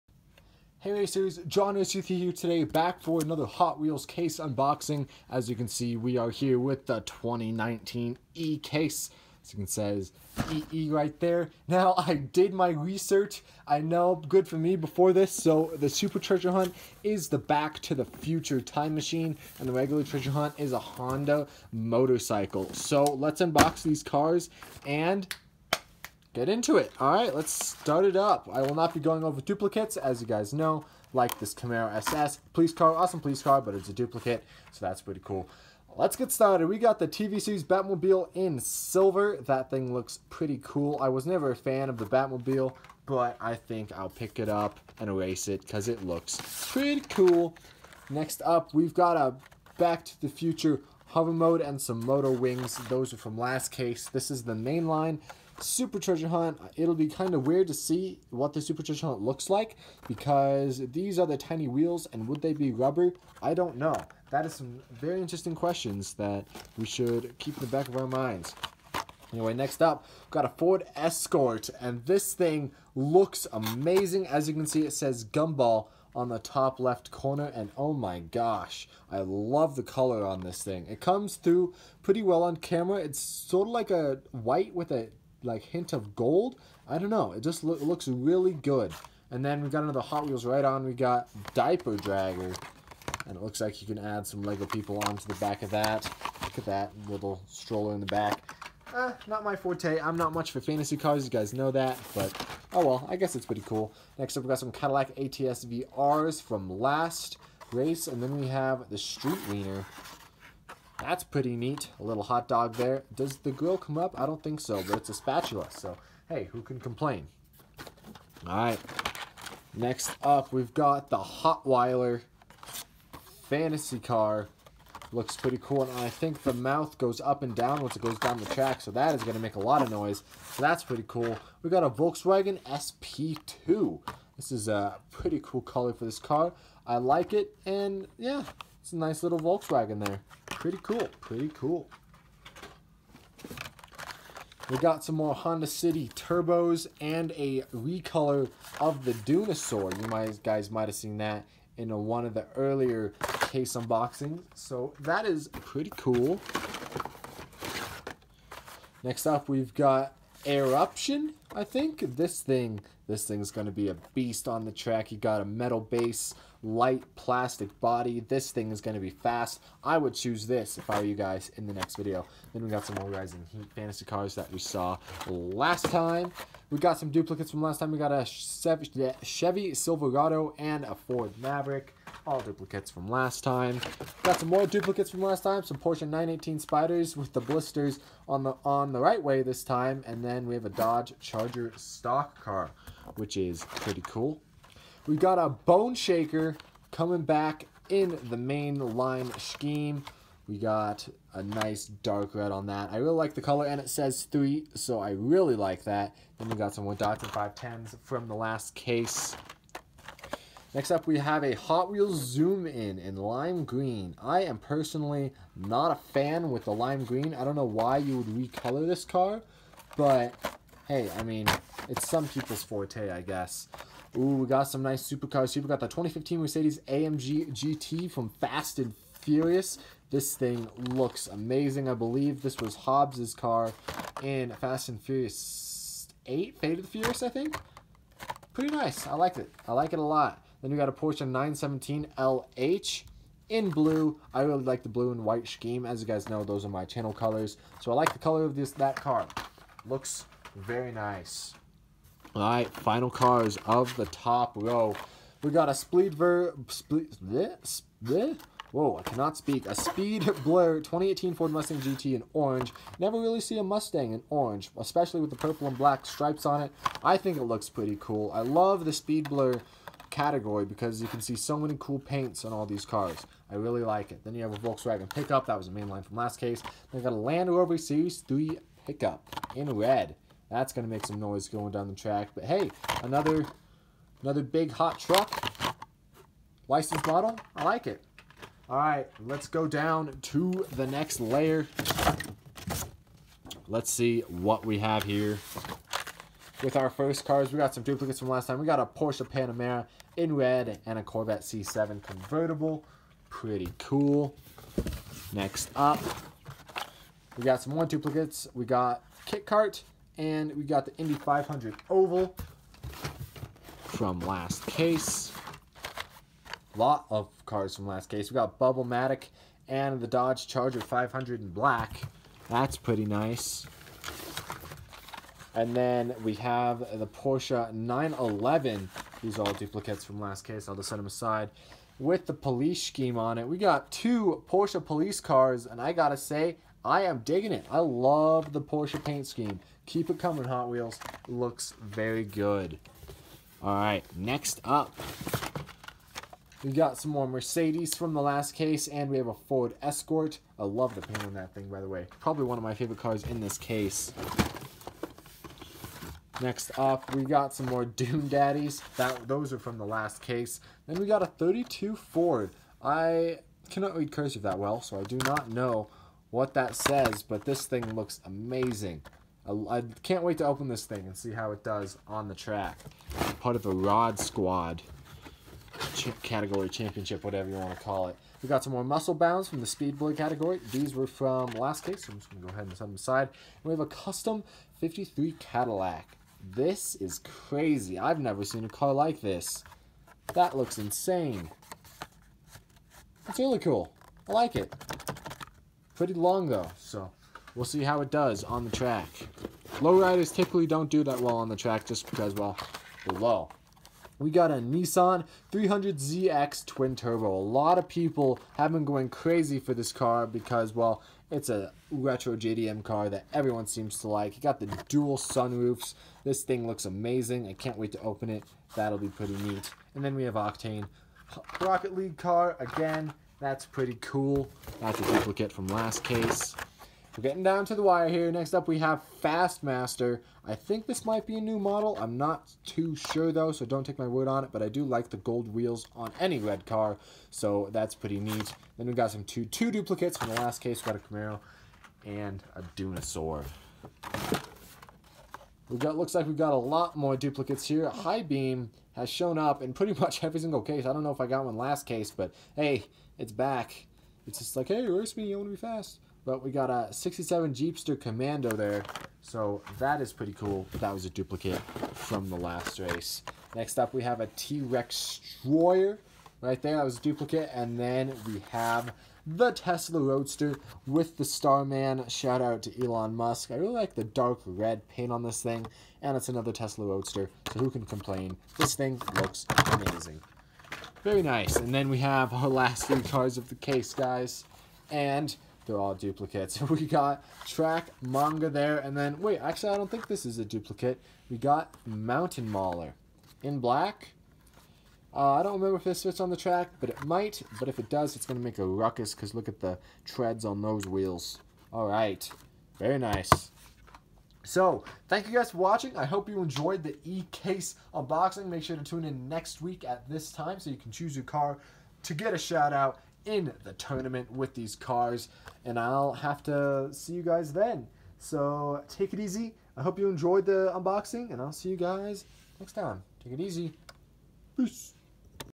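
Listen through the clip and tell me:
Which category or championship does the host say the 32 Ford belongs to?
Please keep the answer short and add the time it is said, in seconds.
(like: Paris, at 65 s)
Rod Squad, at 373 s.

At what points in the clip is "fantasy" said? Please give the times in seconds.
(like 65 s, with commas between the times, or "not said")
100 s, 123 s, 173 s.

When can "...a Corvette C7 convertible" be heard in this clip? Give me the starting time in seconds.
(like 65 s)
300 s.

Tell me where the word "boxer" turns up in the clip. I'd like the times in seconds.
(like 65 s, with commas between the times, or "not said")
not said.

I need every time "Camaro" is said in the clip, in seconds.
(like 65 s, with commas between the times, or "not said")
31 s, 441 s.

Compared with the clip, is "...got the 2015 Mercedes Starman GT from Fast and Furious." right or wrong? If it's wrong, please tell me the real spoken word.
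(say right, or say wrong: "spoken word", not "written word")
wrong: "AMG", not "Starman".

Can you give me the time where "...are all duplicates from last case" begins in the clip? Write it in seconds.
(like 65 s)
329 s.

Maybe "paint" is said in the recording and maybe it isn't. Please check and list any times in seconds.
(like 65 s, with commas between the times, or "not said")
271 s, 339 s, 351 s, 474 s.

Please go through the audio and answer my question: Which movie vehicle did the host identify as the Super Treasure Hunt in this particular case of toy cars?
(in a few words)
Back to the Future time machine.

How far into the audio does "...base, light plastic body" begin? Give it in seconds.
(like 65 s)
165 s.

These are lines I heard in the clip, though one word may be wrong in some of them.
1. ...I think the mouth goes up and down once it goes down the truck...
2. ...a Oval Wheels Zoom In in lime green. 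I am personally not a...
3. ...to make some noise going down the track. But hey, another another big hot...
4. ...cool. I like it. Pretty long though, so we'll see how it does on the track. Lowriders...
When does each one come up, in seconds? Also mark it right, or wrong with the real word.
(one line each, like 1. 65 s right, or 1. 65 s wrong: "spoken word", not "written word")
1. 125 s wrong: "track", not "truck"
2. 211 s wrong: "Hot", not "Oval"
3. 280 s right
4. 393 s right.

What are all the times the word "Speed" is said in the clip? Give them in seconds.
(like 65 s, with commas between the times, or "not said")
259 s, 268 s, 379 s.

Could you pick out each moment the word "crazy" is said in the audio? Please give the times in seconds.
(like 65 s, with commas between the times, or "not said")
387 s, 409 s.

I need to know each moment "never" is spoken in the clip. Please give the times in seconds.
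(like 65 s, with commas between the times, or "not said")
41 s, 262 s, 388 s.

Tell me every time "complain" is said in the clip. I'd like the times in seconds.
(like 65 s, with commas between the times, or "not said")
116 s, 477 s.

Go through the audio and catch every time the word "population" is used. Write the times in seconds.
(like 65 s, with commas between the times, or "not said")
not said.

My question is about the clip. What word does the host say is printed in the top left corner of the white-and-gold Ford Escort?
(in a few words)
Gumball.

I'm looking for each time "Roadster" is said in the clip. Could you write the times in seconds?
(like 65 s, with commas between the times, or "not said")
469 s, 476 s.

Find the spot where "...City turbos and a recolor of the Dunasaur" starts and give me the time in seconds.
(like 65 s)
145 s.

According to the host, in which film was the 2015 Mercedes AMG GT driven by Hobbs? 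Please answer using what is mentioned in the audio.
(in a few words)
Fate of the Furious.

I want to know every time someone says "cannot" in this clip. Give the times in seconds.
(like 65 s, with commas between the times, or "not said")
259 s, 363 s.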